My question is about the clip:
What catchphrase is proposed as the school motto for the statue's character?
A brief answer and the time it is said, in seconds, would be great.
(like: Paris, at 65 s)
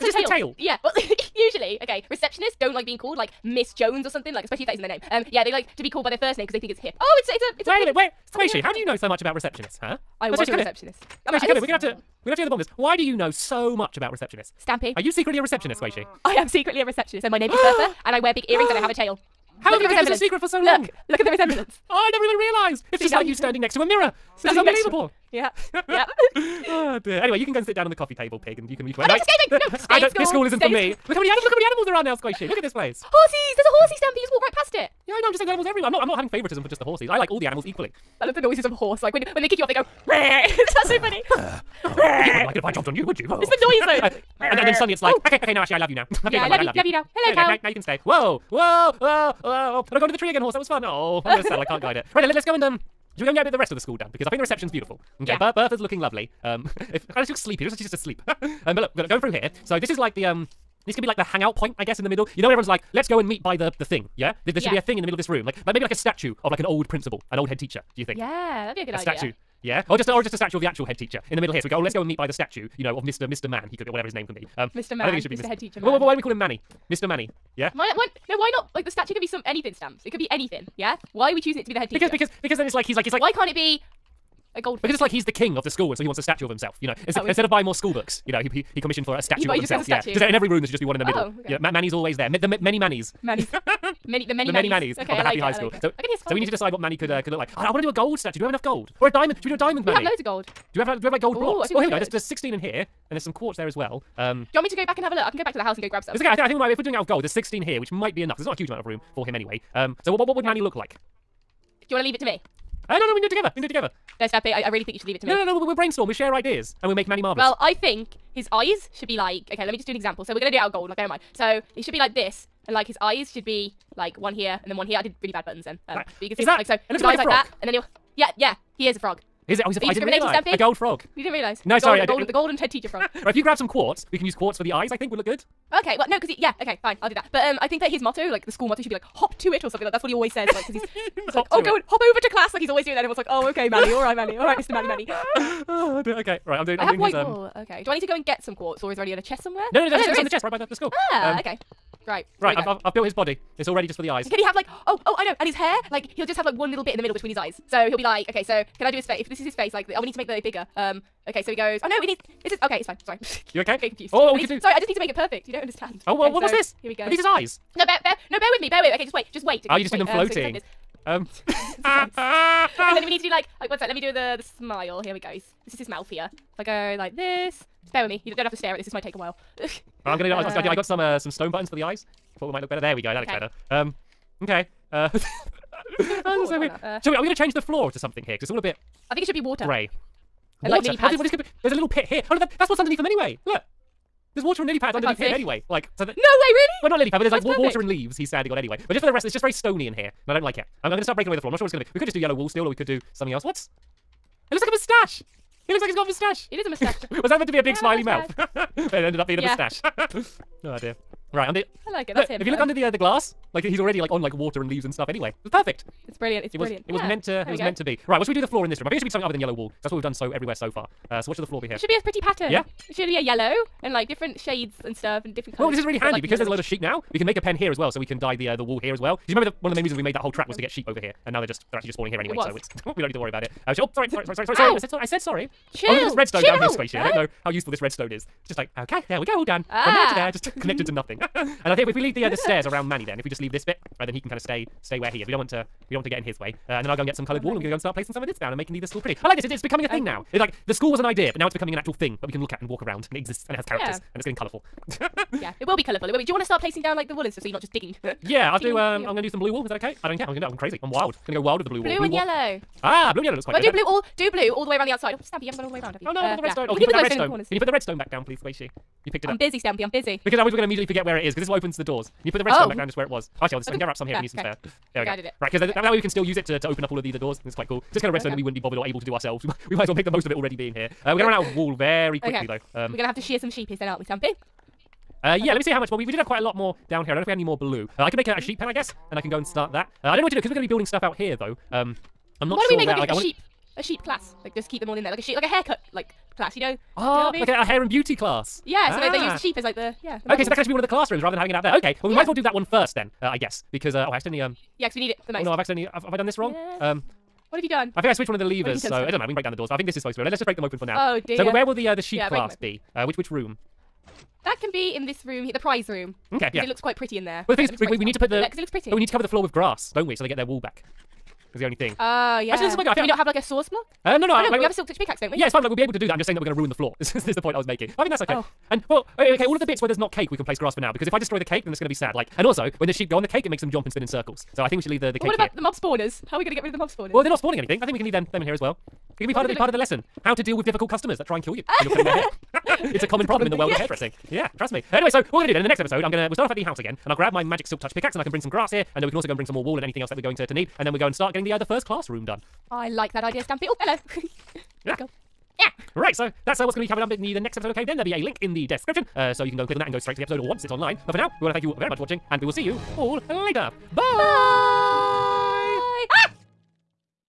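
Hop to it, at 139 s.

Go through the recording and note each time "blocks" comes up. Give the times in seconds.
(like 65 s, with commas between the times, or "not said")
101 s, 323 s.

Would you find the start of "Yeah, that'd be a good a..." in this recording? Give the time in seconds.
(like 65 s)
68 s.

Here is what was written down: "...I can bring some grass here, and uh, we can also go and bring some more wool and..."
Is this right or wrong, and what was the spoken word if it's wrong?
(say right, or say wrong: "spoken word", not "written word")
right.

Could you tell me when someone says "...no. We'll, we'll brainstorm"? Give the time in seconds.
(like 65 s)
115 s.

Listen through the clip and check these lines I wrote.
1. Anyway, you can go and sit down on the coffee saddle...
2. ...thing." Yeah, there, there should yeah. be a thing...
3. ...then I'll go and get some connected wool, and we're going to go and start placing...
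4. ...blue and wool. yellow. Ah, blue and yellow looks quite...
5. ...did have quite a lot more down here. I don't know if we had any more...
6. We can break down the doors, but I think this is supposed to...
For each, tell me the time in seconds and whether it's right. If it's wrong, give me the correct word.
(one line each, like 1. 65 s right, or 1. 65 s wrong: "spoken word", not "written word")
1. 27 s wrong: "table", not "saddle"
2. 63 s right
3. 246 s wrong: "coloured", not "connected"
4. 261 s right
5. 286 s right
6. 309 s right.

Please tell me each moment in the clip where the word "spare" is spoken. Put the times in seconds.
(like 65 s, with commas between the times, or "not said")
274 s.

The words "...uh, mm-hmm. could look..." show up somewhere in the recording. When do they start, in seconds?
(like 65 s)
97 s.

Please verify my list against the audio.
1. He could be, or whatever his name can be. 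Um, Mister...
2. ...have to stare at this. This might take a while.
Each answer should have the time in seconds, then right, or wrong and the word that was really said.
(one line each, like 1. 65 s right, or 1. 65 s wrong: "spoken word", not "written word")
1. 73 s right
2. 178 s right.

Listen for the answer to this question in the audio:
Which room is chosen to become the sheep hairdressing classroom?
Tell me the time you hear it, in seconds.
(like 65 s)
315 s.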